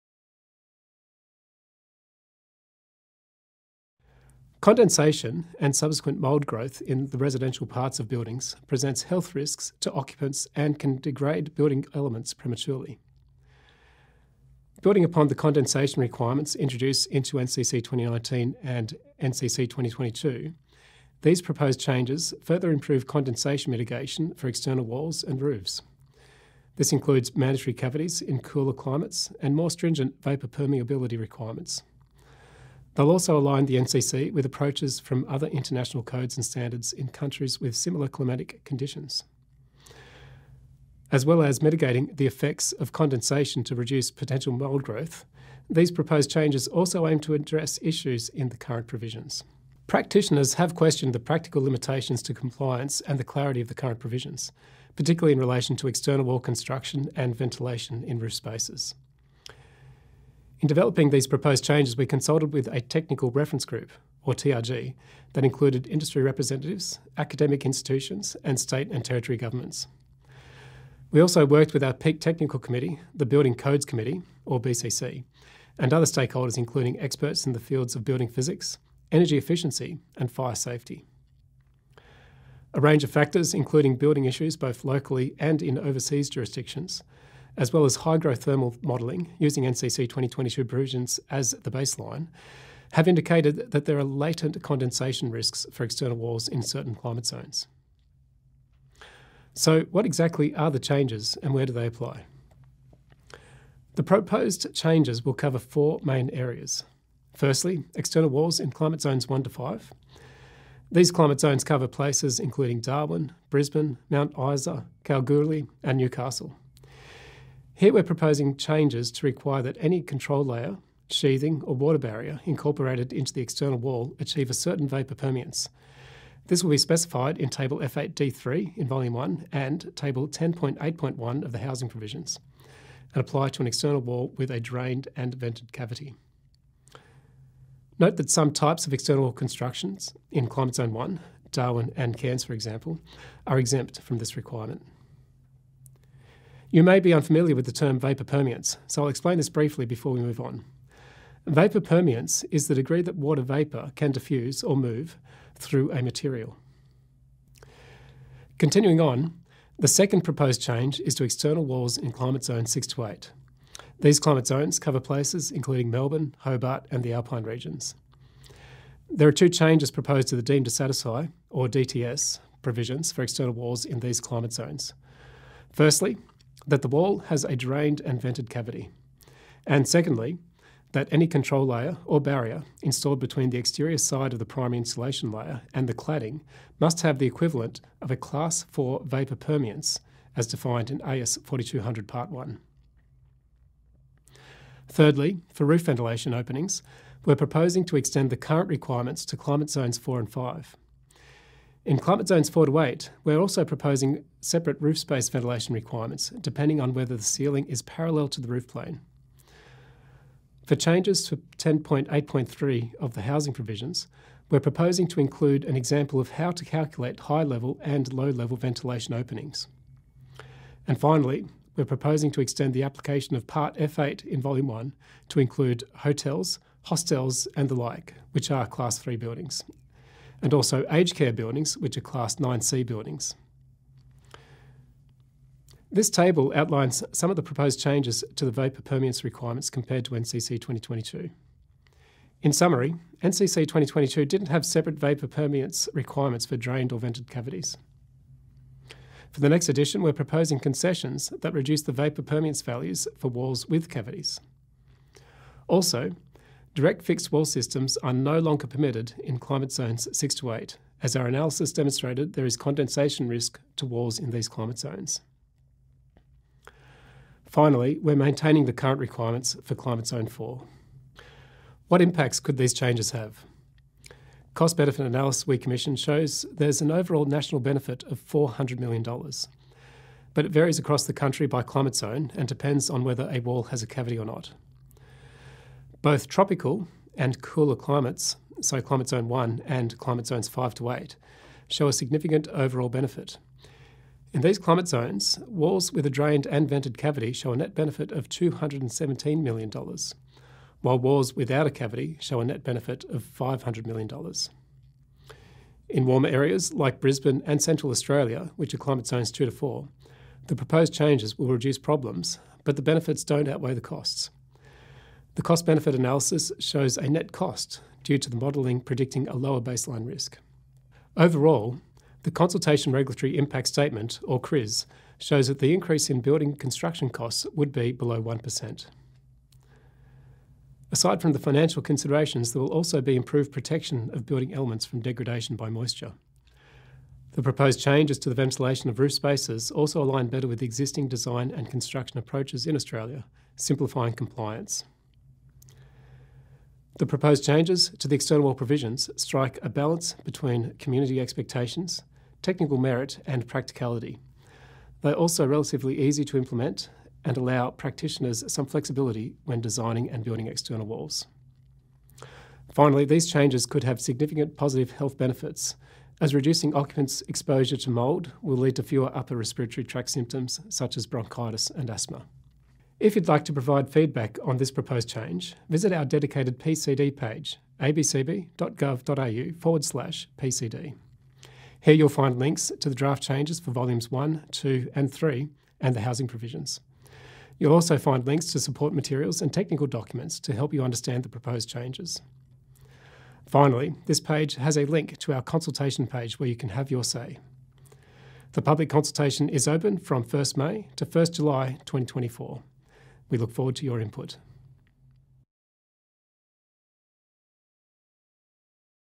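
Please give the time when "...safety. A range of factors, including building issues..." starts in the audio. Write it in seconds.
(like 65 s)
80 s.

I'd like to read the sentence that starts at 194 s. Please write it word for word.
Thirdly, for roof ventilation openings, we're proposing to extend the current requirements to climate zones 4 and 5.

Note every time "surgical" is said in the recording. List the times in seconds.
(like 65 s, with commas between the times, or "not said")
not said.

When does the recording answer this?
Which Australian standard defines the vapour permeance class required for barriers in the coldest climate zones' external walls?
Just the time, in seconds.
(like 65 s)
191 s.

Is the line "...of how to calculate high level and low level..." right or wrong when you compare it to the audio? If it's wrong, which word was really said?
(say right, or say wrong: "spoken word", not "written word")
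right.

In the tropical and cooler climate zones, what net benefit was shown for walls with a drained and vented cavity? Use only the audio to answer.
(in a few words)
$217 million.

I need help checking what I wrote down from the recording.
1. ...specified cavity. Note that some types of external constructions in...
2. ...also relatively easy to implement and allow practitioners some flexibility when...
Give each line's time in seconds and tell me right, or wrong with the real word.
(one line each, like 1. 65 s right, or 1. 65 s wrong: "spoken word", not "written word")
1. 135 s wrong: "vented", not "specified"
2. 355 s right.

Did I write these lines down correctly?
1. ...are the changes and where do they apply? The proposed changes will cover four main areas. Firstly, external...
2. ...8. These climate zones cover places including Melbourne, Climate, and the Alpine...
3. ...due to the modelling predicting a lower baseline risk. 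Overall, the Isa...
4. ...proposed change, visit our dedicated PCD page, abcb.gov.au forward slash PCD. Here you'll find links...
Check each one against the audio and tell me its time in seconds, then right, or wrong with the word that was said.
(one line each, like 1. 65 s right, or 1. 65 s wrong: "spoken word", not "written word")
1. 100 s right
2. 163 s wrong: "Hobart", not "Climate"
3. 318 s wrong: "Consultation", not "Isa"
4. 374 s right.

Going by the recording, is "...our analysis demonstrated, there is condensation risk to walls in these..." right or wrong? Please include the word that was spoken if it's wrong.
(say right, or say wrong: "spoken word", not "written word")
right.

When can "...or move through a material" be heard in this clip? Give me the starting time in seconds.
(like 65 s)
154 s.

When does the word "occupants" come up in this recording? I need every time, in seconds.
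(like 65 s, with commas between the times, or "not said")
9 s, 366 s.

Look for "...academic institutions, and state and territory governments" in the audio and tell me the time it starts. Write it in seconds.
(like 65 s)
67 s.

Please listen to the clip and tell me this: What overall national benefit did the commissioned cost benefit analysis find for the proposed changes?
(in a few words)
$400 million.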